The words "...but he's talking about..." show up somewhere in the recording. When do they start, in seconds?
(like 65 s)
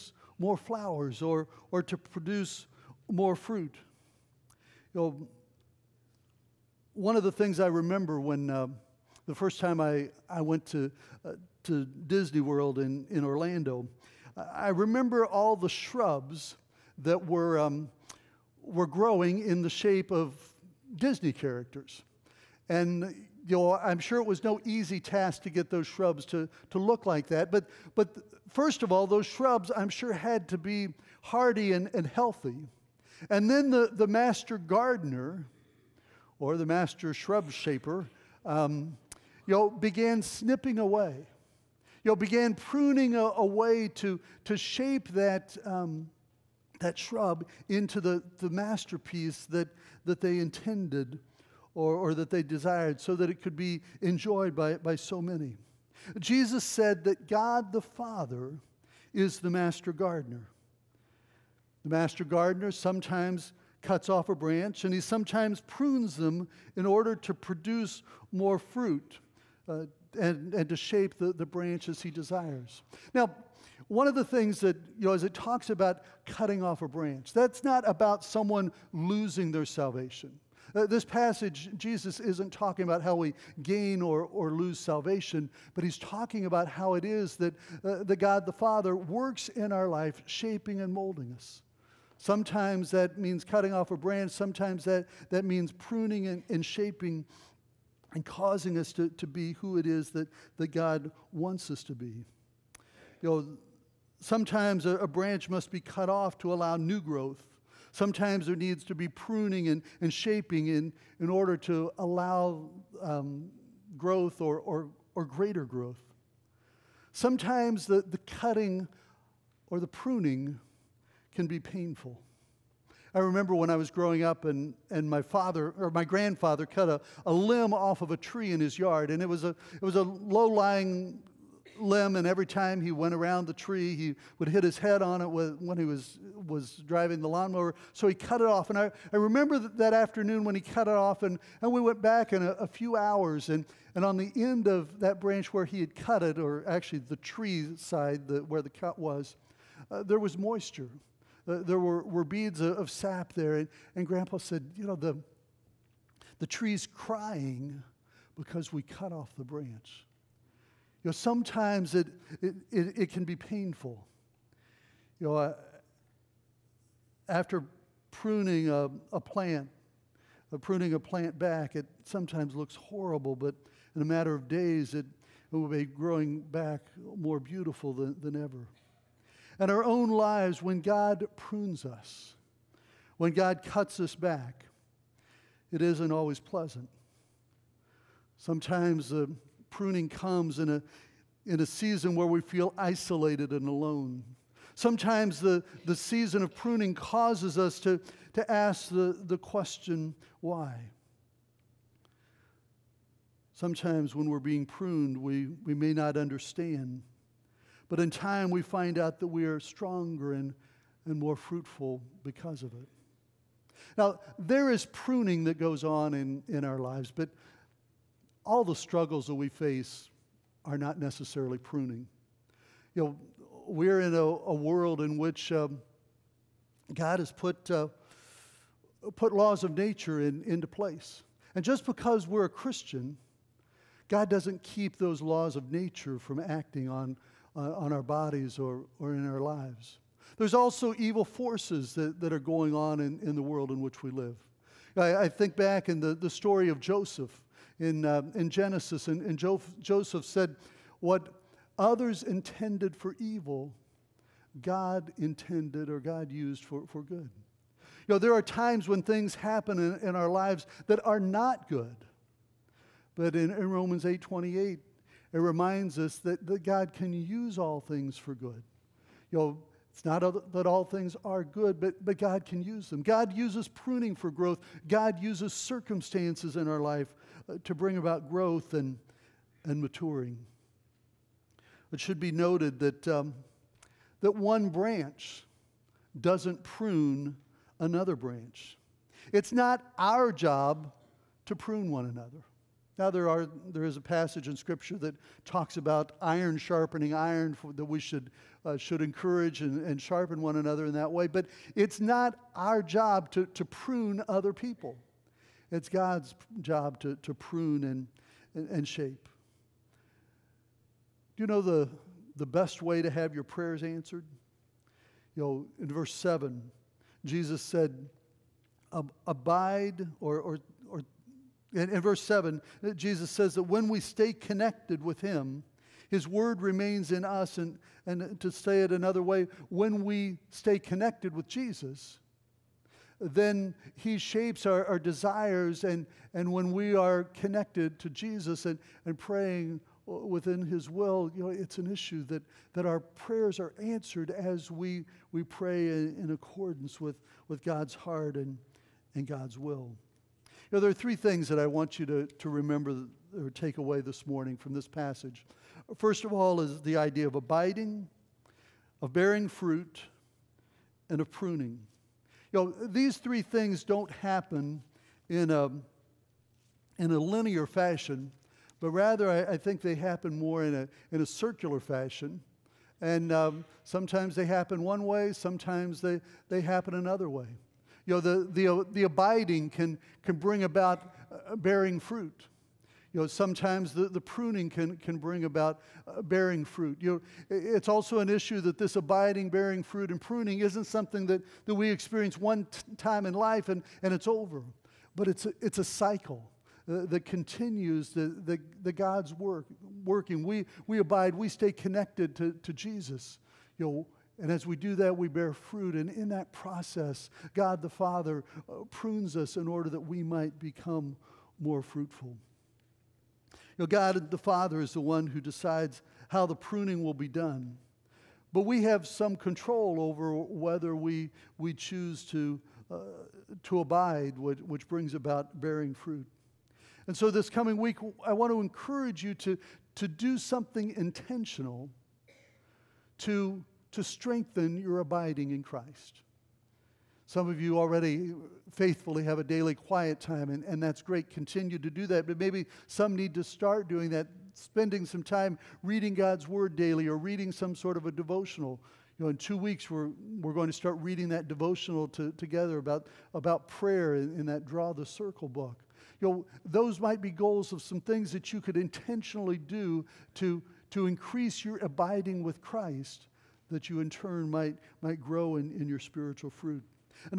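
85 s.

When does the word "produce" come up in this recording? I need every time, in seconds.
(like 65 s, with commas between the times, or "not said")
1 s, 67 s.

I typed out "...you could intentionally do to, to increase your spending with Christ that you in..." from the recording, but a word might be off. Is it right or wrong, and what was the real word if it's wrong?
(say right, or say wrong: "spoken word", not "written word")
wrong: "abiding", not "spending".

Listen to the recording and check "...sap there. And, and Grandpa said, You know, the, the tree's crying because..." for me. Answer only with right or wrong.
right.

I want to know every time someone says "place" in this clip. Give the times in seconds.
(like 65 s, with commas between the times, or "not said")
230 s.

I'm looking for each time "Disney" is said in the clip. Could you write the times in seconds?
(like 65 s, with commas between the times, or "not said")
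12 s, 20 s.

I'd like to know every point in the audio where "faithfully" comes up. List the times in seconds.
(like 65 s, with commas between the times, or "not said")
438 s.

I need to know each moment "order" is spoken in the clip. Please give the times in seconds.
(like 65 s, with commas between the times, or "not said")
66 s, 111 s, 409 s.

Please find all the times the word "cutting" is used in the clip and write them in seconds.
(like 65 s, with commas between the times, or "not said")
76 s, 93 s, 118 s.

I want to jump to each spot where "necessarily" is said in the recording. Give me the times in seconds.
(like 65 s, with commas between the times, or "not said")
220 s.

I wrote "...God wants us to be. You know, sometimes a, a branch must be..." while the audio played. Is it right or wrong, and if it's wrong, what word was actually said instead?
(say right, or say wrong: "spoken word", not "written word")
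right.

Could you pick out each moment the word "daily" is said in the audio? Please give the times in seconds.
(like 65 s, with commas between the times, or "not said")
439 s, 446 s.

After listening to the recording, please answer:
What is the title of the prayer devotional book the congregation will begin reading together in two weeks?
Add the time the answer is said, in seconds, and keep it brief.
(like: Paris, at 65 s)
Draw the Circle, at 454 s.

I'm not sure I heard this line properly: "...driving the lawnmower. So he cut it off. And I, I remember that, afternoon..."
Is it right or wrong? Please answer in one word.
right.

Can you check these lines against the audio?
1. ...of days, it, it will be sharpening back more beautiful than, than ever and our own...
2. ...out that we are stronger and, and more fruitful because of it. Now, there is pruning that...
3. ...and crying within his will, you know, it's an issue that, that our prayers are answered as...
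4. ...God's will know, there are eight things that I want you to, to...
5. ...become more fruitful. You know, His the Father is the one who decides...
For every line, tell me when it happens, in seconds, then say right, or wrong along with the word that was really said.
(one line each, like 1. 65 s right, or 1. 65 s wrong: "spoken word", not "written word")
1. 174 s wrong: "growing", not "sharpening"
2. 208 s right
3. 339 s wrong: "praying", not "crying"
4. 349 s wrong: "three", not "eight"
5. 410 s wrong: "God", not "His".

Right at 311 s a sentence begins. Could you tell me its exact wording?
Do you know the, the best way to have your prayers answered?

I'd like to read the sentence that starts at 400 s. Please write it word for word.
We, we abide, we stay connected to, to Jesus.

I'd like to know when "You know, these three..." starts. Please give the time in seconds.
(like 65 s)
362 s.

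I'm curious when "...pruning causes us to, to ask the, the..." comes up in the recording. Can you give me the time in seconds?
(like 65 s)
196 s.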